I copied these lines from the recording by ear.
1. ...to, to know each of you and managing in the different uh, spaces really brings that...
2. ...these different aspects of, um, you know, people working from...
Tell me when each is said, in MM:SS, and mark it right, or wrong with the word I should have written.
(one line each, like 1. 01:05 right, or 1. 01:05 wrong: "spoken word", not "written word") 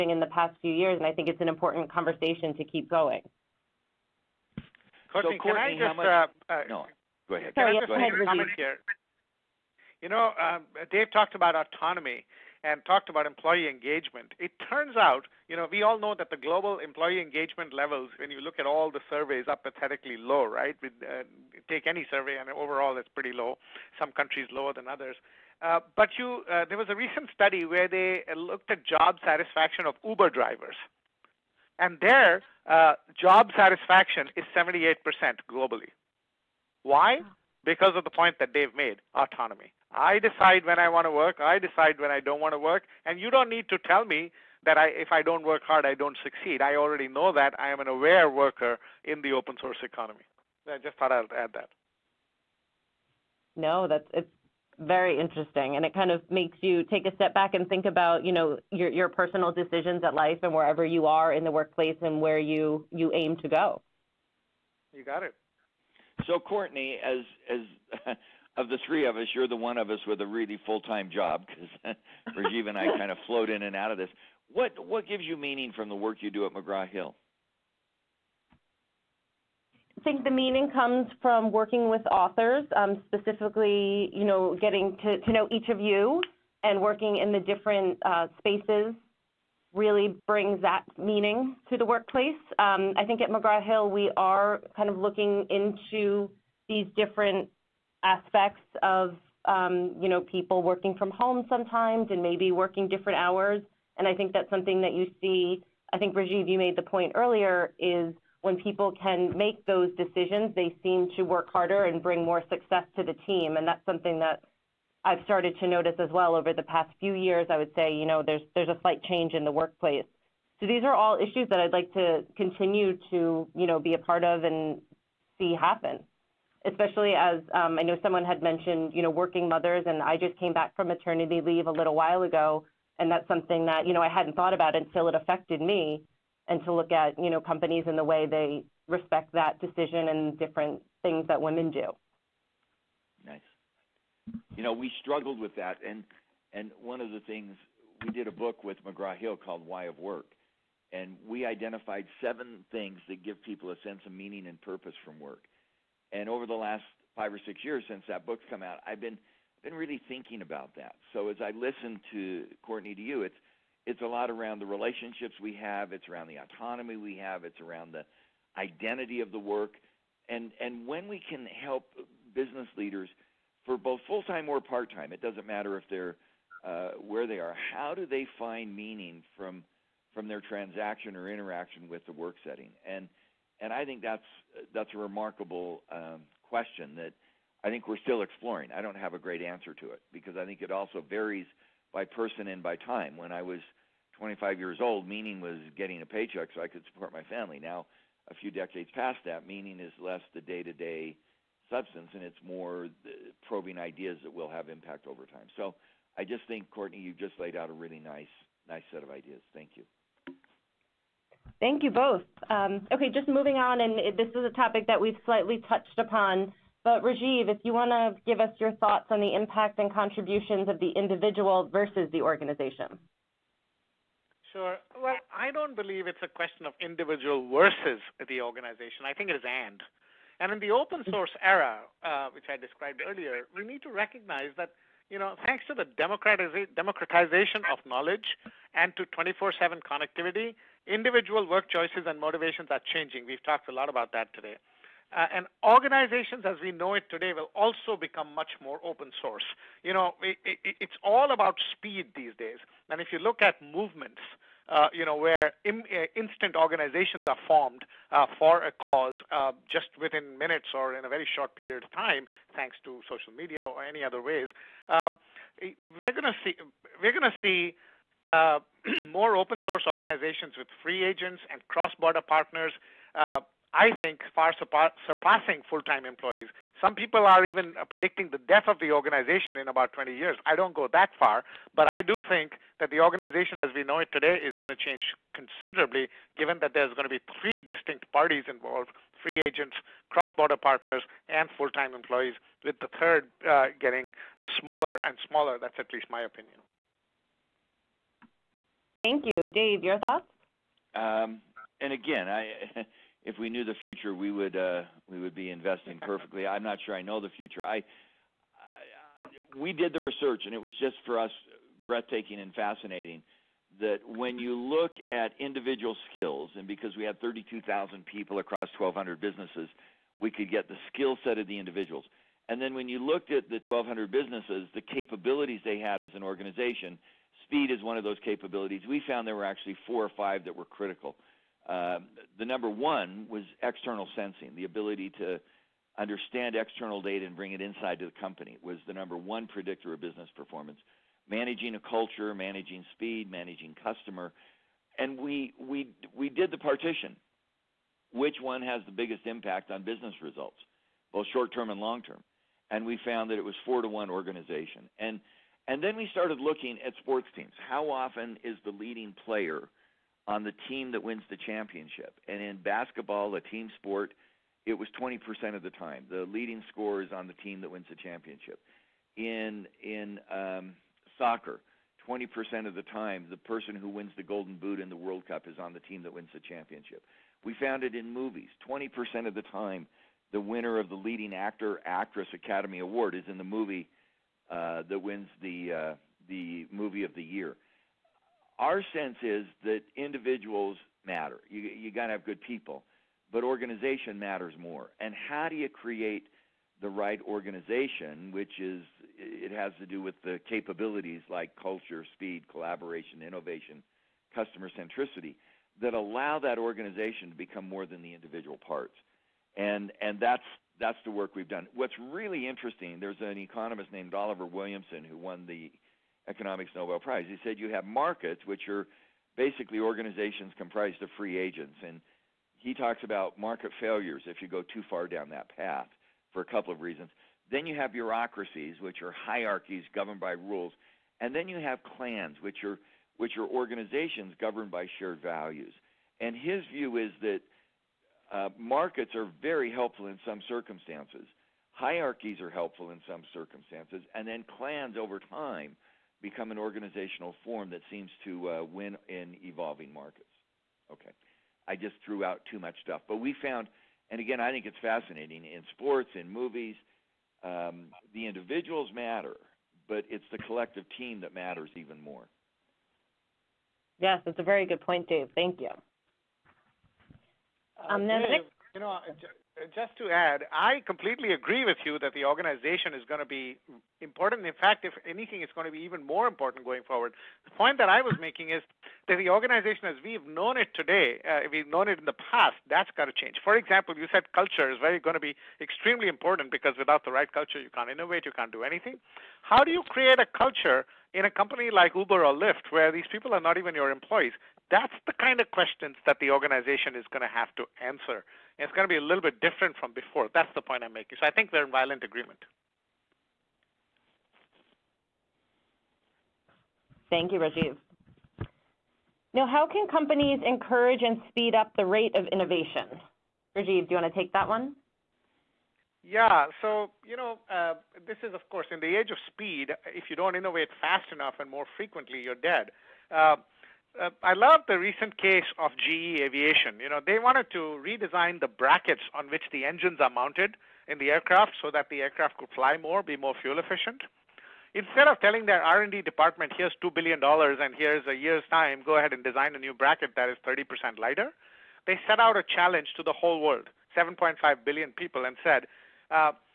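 1. 01:25 wrong: "working", not "managing"
2. 01:36 right.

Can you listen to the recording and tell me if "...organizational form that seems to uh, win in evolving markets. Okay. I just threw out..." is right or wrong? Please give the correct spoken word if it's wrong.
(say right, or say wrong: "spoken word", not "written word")
right.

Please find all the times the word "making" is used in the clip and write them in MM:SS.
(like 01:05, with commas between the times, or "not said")
07:58, 08:20.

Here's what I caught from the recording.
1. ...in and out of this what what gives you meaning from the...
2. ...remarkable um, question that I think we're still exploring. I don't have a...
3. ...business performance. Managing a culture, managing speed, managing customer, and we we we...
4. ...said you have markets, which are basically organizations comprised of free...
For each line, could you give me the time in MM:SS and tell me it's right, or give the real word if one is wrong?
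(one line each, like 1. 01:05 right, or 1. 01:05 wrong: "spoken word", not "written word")
1. 01:13 right
2. 03:04 right
3. 05:39 right
4. 06:57 right.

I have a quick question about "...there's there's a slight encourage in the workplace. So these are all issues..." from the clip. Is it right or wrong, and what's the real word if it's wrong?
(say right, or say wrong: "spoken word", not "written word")
wrong: "change", not "encourage".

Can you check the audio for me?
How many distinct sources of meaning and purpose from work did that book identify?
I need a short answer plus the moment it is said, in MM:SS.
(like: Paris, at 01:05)
7, at 02:32.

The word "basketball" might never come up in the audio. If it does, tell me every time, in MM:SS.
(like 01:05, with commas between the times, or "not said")
06:02.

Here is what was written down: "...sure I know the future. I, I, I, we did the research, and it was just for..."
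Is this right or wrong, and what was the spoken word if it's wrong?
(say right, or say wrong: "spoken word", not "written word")
right.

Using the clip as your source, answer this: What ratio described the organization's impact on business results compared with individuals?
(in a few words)
4 to 1.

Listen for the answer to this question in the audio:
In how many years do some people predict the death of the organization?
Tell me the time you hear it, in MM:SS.
04:39.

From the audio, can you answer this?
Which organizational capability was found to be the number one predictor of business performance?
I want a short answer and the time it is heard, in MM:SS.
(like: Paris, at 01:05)
External sensing, at 05:33.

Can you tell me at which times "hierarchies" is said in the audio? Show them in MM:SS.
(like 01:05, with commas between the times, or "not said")
07:09, 07:21.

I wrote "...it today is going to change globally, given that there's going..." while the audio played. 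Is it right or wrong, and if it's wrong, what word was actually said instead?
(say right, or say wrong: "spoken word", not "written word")
wrong: "considerably", not "globally".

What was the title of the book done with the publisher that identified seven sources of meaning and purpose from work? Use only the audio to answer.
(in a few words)
Why of Work.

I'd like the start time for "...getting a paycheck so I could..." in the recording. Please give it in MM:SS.
03:15.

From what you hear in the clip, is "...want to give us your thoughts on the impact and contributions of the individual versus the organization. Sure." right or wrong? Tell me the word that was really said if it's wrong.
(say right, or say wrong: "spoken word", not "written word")
right.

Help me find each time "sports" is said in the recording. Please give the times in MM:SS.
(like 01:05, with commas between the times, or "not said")
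05:57, 06:03, 07:35.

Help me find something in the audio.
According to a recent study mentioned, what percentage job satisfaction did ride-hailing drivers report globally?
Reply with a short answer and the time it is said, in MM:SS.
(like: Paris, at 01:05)
78%, at 00:34.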